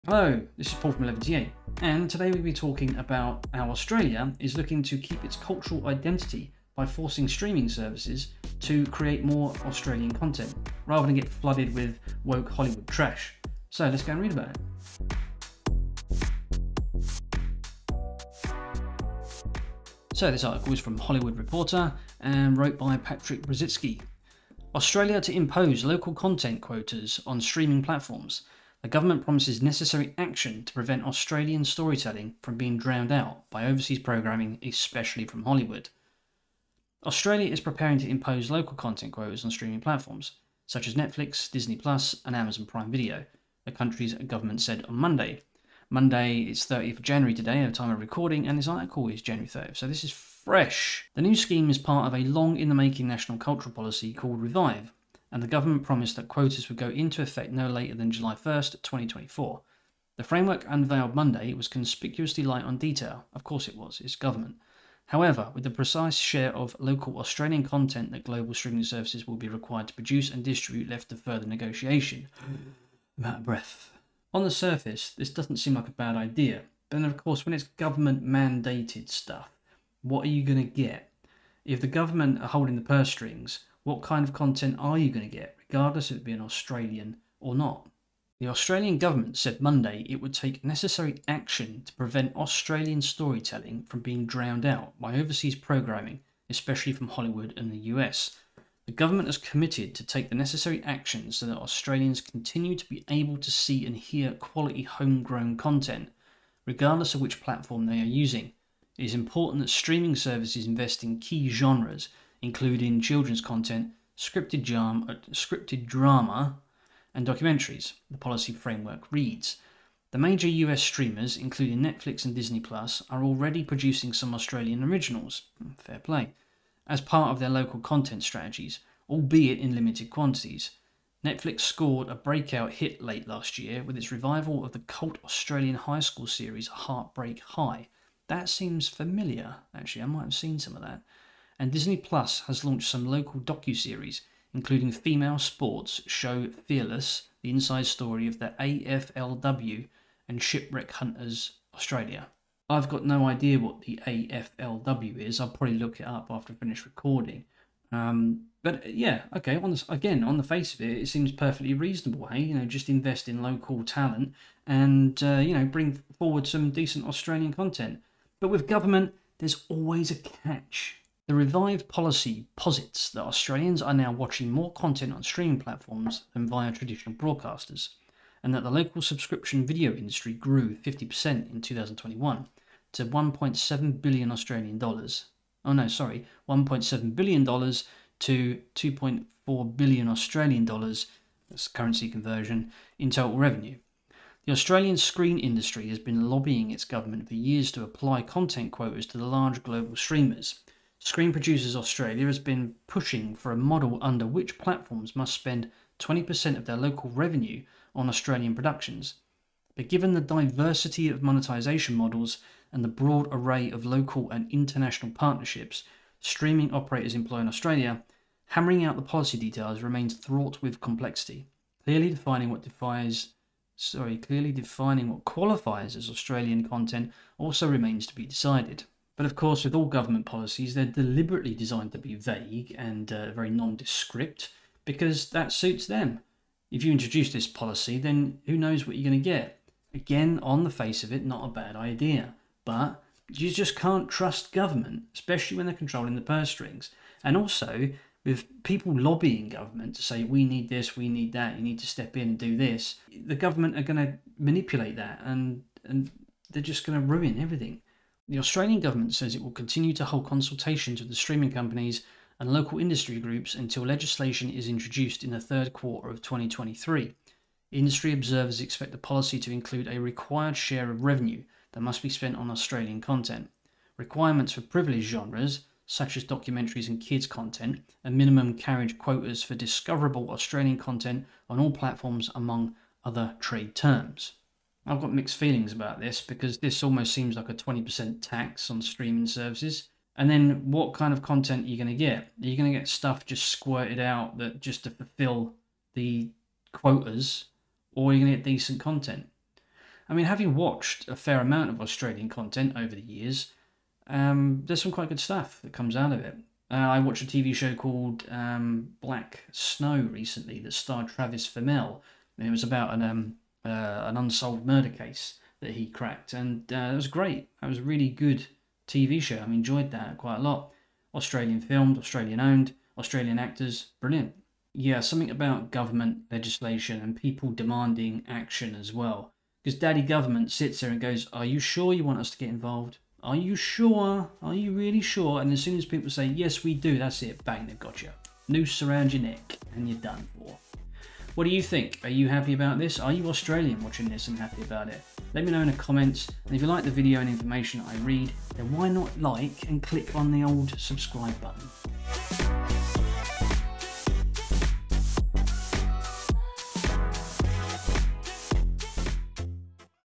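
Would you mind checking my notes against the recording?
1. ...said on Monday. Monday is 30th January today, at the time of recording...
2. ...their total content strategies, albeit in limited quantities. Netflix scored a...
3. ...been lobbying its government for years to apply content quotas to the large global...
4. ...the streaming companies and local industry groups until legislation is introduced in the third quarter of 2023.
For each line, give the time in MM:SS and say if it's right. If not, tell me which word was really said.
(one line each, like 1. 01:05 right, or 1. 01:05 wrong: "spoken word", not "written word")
1. 00:44 right
2. 02:07 wrong: "local", not "total"
3. 03:15 right
4. 04:21 right.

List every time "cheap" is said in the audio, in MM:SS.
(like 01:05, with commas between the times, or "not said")
not said.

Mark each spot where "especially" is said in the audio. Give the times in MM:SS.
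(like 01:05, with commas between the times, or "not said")
00:34, 01:36, 04:05.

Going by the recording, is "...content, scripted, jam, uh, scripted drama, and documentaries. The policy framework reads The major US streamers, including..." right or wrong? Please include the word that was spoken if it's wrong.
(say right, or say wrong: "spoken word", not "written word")
right.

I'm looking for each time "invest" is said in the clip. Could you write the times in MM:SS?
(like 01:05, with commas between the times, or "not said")
01:50, 02:42.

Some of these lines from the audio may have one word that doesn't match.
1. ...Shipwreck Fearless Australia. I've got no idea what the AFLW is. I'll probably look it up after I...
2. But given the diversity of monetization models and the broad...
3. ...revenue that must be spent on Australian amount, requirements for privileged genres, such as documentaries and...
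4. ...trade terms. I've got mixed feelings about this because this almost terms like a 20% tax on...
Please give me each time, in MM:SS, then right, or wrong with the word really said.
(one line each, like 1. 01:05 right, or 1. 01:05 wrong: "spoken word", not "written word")
1. 02:30 wrong: "Hunters", not "Fearless"
2. 03:29 right
3. 04:31 wrong: "content", not "amount"
4. 04:43 wrong: "seems", not "terms".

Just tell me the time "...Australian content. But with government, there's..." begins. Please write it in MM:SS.
02:47.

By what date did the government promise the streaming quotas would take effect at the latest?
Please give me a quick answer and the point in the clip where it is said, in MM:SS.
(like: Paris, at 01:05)
July 1st, 2024, at 00:58.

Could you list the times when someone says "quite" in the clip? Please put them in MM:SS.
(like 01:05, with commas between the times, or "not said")
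05:04, 05:20.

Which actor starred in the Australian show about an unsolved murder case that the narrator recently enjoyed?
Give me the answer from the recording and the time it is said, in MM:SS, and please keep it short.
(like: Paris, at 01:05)
Travis Fimmel, at 05:11.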